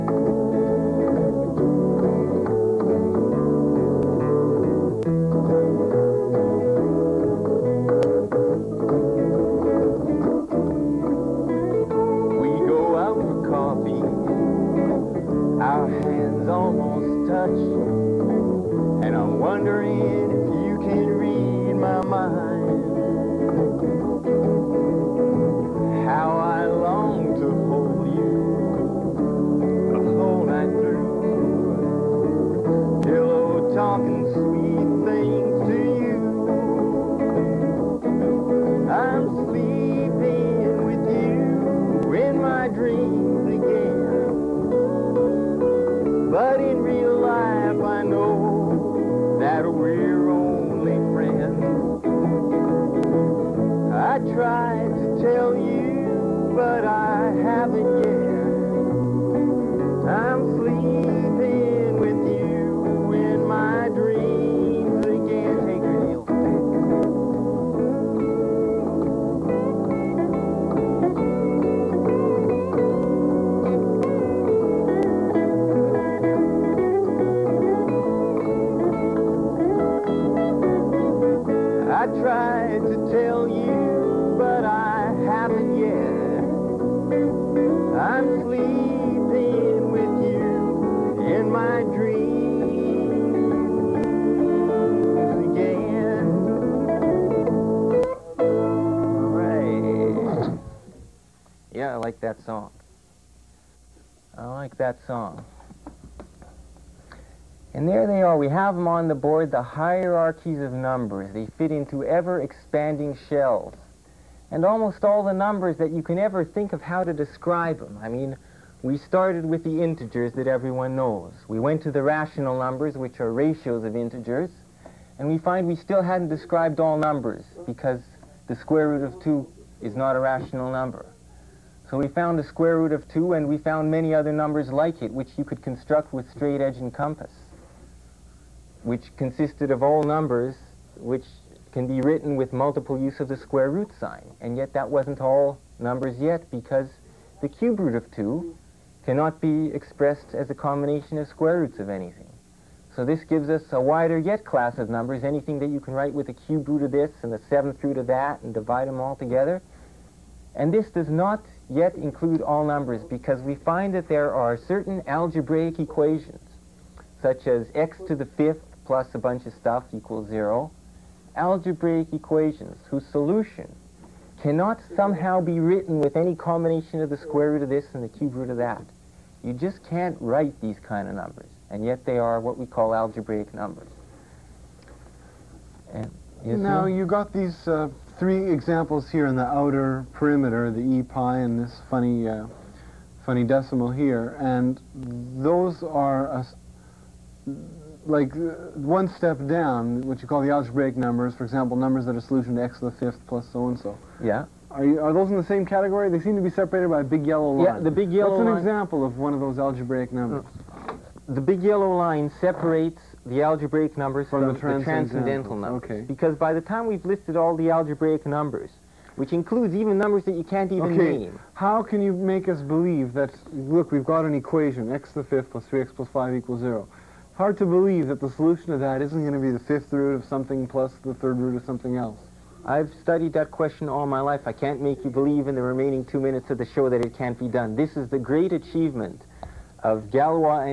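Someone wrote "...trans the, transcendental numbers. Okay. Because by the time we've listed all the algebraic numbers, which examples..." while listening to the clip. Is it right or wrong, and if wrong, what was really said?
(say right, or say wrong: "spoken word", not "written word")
wrong: "includes", not "examples".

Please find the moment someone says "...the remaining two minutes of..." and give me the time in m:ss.
3:55.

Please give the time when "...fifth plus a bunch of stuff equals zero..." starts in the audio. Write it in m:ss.
2:48.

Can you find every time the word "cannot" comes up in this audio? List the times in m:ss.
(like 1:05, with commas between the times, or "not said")
2:29, 2:54.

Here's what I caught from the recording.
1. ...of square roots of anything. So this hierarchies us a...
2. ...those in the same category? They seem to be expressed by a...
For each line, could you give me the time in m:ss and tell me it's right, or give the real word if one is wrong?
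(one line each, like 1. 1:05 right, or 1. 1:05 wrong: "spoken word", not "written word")
1. 2:31 wrong: "gives", not "hierarchies"
2. 3:25 wrong: "separated", not "expressed".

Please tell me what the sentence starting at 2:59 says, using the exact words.
You just can't write these kind of numbers, and yet they are what we call algebraic numbers.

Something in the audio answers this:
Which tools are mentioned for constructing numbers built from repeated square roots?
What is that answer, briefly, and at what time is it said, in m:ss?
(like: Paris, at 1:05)
straight edge and compass, at 2:16.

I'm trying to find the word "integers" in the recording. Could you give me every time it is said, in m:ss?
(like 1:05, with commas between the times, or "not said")
1:59, 2:03.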